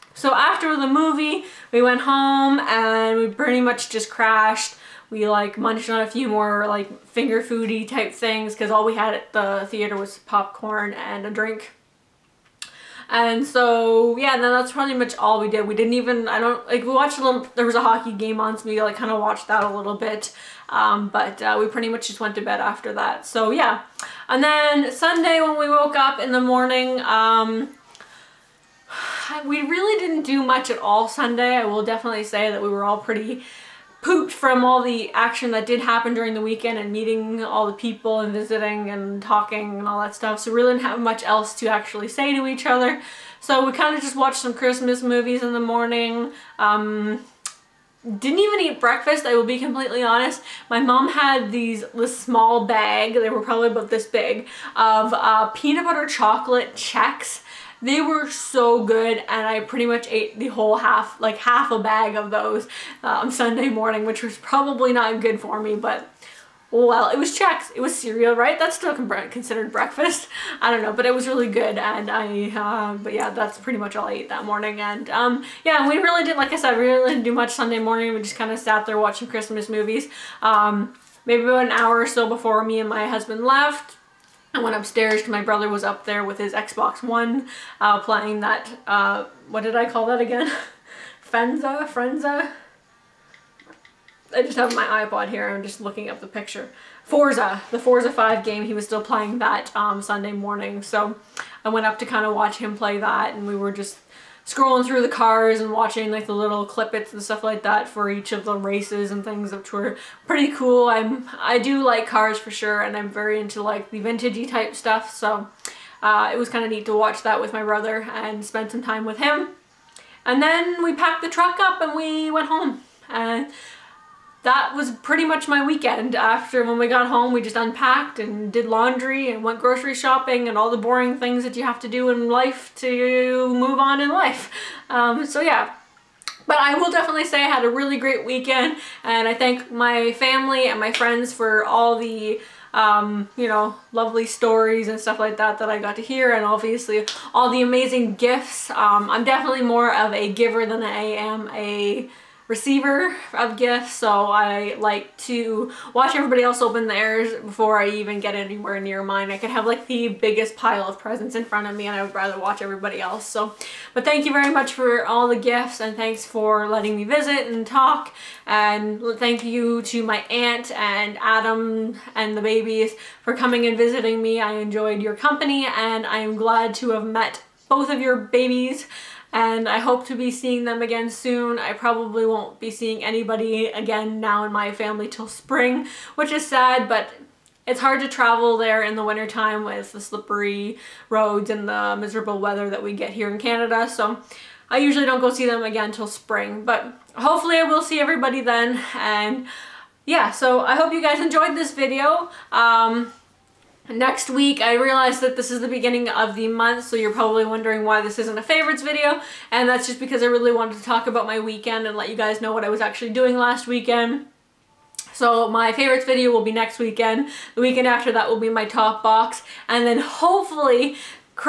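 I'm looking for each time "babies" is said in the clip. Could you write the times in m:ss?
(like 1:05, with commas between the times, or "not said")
2:52, 2:58.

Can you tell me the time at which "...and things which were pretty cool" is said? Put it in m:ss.
1:49.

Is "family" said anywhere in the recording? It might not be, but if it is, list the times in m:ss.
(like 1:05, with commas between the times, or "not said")
2:20, 3:04.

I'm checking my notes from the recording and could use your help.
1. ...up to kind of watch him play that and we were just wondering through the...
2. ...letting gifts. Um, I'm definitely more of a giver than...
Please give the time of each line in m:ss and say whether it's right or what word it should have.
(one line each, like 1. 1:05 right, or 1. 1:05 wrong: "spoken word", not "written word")
1. 1:41 wrong: "scrolling", not "wondering"
2. 2:27 wrong: "amazing", not "letting".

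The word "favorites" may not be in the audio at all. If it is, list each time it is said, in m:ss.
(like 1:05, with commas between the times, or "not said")
3:28, 3:35.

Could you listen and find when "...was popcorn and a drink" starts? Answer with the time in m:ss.
0:09.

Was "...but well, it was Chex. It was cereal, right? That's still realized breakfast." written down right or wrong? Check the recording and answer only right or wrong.
wrong.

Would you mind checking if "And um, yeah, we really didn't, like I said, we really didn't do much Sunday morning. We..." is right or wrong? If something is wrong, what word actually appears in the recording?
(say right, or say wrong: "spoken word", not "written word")
right.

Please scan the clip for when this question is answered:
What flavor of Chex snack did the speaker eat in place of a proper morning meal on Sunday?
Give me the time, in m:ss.
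0:55.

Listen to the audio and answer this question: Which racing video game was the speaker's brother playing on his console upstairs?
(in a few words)
Forza 5.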